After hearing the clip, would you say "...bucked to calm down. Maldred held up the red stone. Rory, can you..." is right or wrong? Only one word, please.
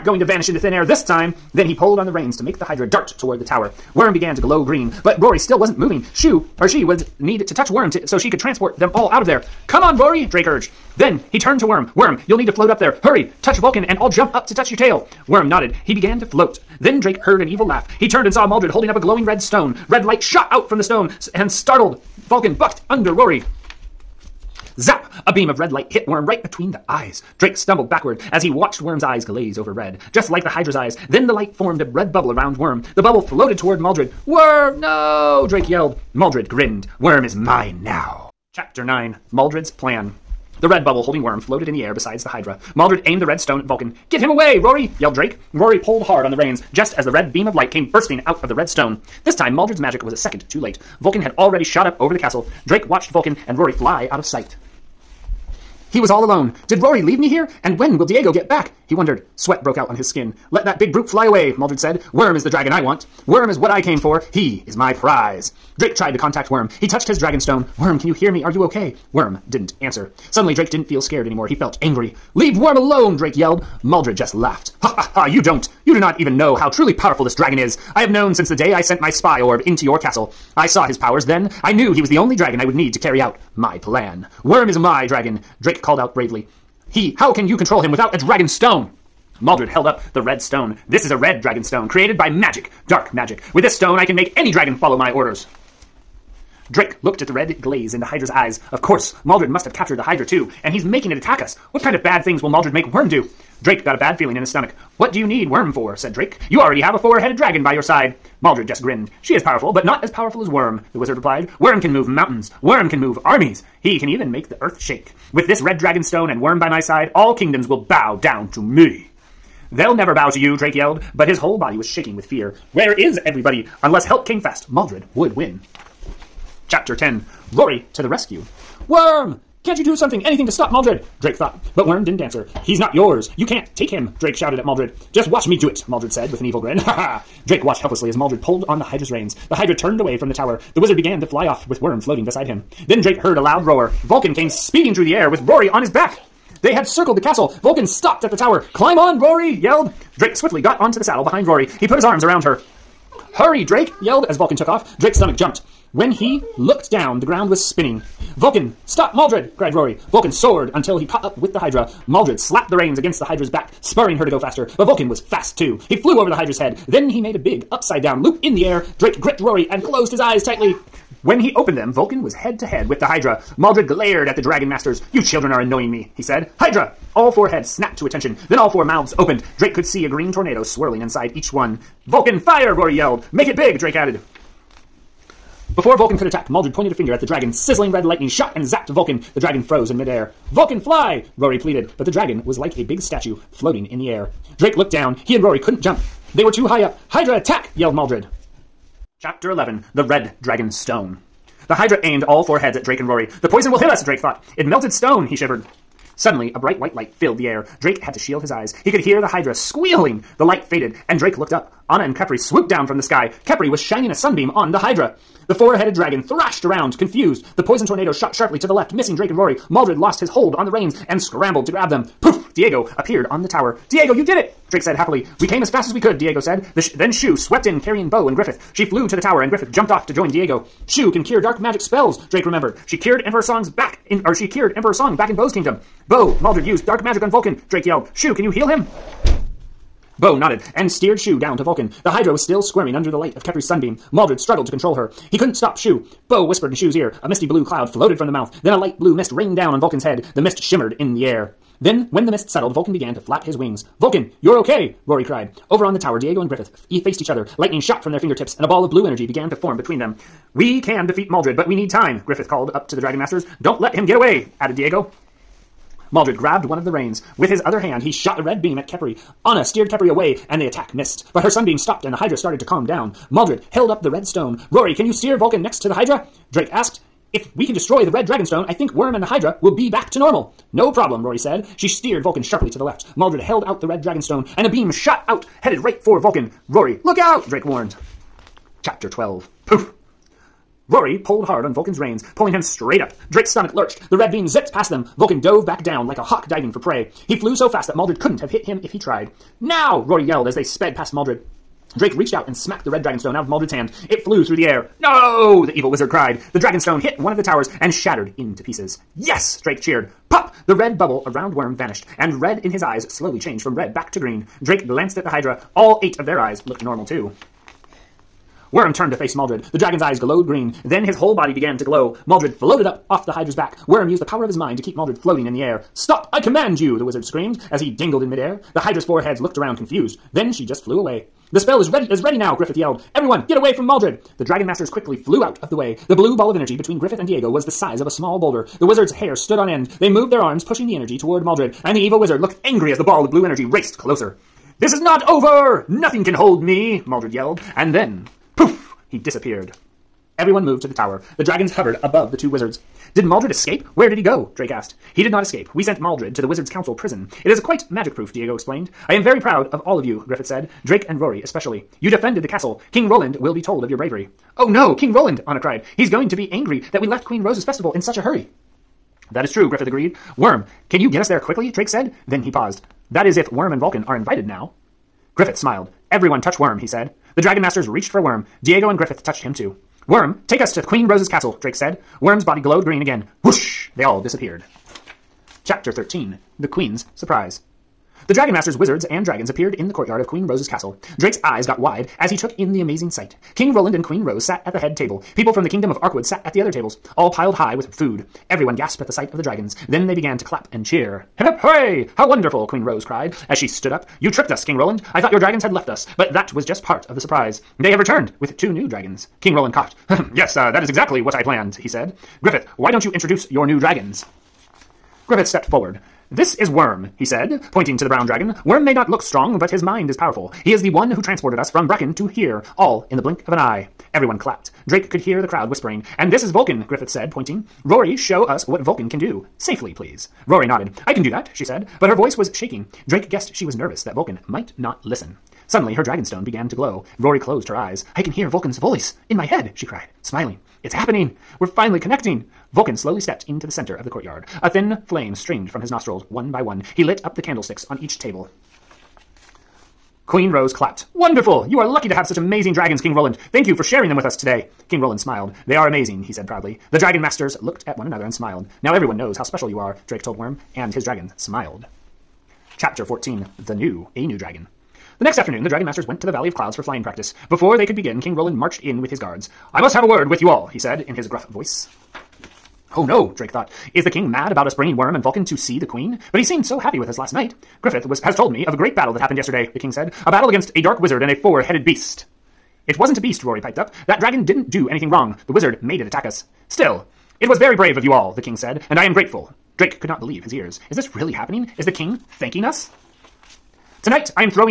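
wrong.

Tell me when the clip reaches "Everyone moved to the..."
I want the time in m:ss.
5:50.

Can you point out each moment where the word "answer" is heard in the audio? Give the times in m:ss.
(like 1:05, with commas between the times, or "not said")
1:09, 2:12.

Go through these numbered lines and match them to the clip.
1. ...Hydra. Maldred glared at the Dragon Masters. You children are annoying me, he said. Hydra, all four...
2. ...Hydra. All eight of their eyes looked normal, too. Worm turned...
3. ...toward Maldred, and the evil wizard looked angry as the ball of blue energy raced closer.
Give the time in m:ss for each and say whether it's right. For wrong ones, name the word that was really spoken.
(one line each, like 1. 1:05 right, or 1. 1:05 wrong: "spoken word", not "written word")
1. 2:53 right
2. 5:15 right
3. 5:41 right.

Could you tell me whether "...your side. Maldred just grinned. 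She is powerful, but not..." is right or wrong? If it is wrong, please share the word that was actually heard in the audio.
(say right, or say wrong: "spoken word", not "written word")
right.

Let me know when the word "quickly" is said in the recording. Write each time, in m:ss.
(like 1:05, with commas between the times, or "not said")
5:34, 6:11.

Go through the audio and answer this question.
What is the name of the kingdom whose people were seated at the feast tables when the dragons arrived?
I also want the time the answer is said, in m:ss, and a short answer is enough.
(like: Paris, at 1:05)
Arkwood, at 6:36.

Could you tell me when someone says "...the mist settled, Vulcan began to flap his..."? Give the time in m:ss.
4:12.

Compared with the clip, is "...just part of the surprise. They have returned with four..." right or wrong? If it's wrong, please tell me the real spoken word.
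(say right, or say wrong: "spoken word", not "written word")
wrong: "two", not "four".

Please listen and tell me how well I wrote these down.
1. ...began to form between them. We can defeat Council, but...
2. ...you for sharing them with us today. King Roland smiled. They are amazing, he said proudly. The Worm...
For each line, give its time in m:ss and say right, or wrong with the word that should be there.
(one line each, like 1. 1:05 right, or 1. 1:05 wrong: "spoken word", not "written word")
1. 4:19 wrong: "Maldred", not "Council"
2. 7:33 wrong: "Dragon", not "Worm".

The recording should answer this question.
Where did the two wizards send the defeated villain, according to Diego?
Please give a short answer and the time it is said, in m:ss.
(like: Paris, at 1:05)
Wizard's Council prison, at 5:56.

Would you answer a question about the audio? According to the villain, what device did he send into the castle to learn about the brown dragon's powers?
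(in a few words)
Spy orb.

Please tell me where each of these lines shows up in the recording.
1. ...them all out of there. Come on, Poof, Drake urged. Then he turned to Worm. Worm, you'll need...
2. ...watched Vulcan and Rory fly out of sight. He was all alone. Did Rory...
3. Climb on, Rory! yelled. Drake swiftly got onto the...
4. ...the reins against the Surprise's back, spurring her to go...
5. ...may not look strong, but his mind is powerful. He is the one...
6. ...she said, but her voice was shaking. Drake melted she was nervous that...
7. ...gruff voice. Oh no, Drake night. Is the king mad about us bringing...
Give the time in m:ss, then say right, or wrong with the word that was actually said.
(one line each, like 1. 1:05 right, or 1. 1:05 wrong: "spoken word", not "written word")
1. 0:08 wrong: "Rory", not "Poof"
2. 0:52 right
3. 2:28 right
4. 2:42 wrong: "Hydra", not "Surprise"
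5. 6:58 right
6. 7:11 wrong: "guessed", not "melted"
7. 7:51 wrong: "thought", not "night".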